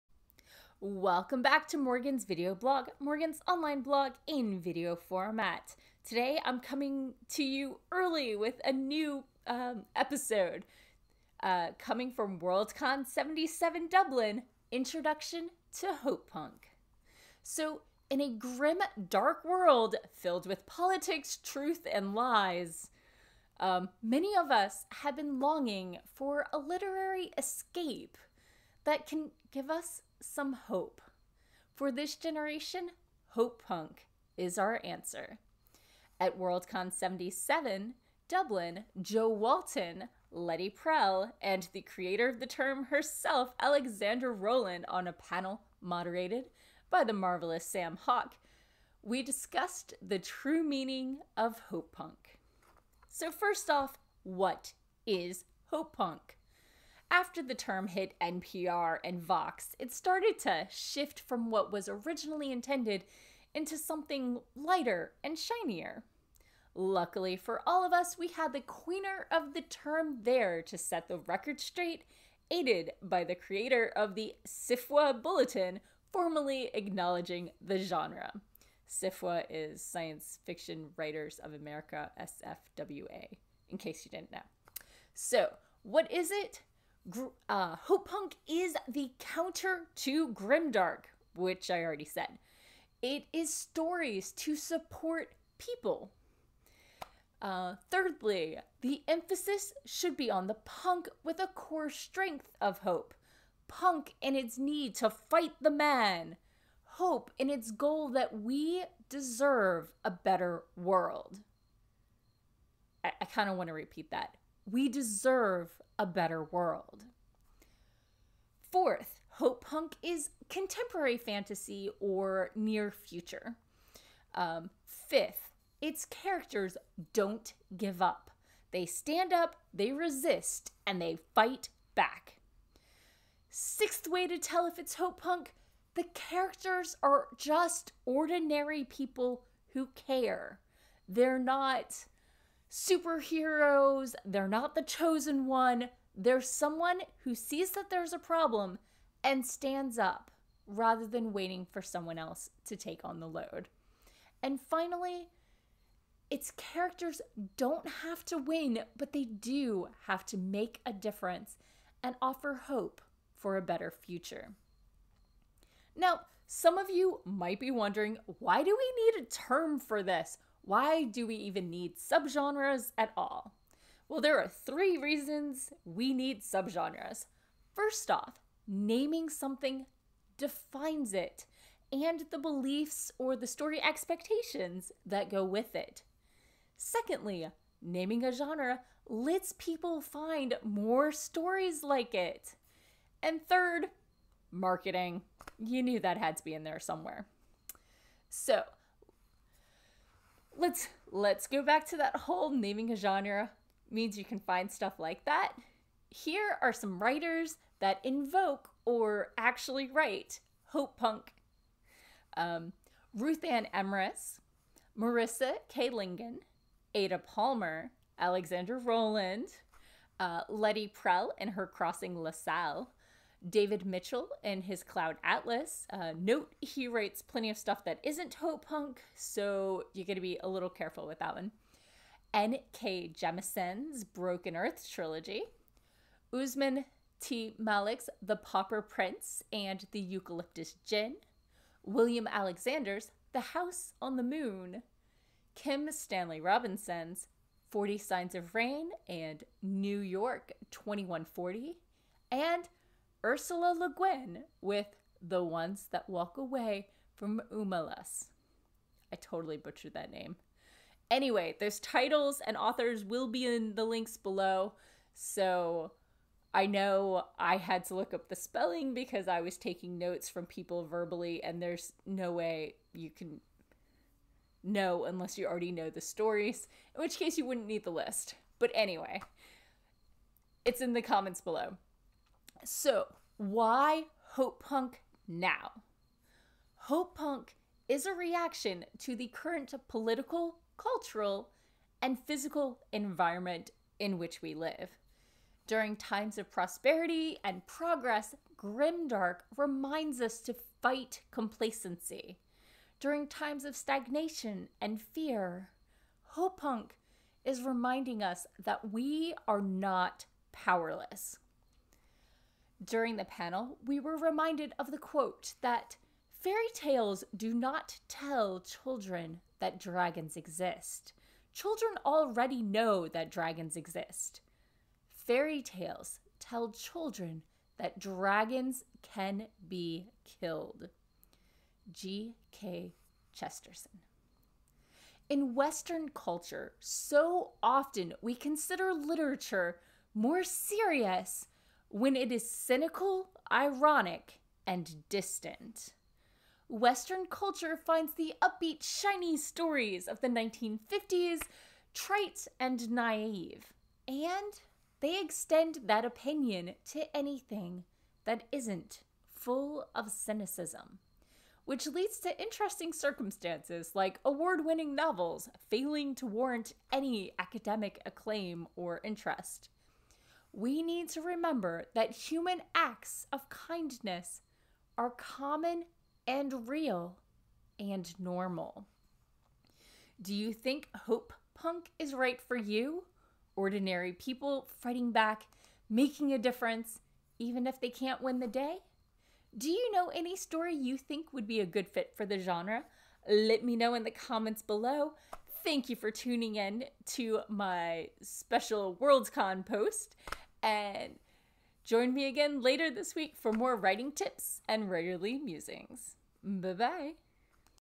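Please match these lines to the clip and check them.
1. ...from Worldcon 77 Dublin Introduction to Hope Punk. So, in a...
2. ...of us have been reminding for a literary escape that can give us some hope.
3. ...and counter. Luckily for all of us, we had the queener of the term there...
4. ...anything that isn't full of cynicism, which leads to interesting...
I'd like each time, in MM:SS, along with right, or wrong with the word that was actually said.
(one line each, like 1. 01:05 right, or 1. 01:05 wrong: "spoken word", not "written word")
1. 00:12 right
2. 00:24 wrong: "longing", not "reminding"
3. 01:05 wrong: "shinier", not "counter"
4. 05:57 right.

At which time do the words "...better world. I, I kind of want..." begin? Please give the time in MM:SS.
01:50.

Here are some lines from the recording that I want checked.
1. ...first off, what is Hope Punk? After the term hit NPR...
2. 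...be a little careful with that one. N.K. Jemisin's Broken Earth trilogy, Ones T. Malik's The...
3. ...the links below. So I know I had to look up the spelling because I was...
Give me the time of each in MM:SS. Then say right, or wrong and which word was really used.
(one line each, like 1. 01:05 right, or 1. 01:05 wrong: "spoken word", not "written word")
1. 00:53 right
2. 03:50 wrong: "Usman", not "Ones"
3. 04:23 right.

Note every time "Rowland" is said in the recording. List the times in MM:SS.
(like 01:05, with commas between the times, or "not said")
00:44, 03:38.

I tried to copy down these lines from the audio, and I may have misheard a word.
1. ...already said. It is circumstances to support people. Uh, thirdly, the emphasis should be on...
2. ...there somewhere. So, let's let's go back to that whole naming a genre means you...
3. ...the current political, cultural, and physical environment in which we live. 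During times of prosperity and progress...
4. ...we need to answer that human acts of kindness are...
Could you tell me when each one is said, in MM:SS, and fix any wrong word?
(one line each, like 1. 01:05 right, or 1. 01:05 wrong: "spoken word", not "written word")
1. 01:31 wrong: "stories", not "circumstances"
2. 03:16 right
3. 04:49 right
4. 06:10 wrong: "remember", not "answer".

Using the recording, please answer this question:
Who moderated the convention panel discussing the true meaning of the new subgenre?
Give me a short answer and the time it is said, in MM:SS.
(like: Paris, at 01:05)
Sam Hawke, at 00:47.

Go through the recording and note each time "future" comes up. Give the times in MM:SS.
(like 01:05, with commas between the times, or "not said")
02:02, 02:43.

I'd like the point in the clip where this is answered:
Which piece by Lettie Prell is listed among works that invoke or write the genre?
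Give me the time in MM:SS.
03:41.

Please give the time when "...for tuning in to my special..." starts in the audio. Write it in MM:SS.
06:35.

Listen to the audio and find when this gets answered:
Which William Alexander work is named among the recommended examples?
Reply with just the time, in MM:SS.
04:03.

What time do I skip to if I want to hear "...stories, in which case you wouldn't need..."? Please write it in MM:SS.
04:36.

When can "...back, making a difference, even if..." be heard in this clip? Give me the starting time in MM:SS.
06:25.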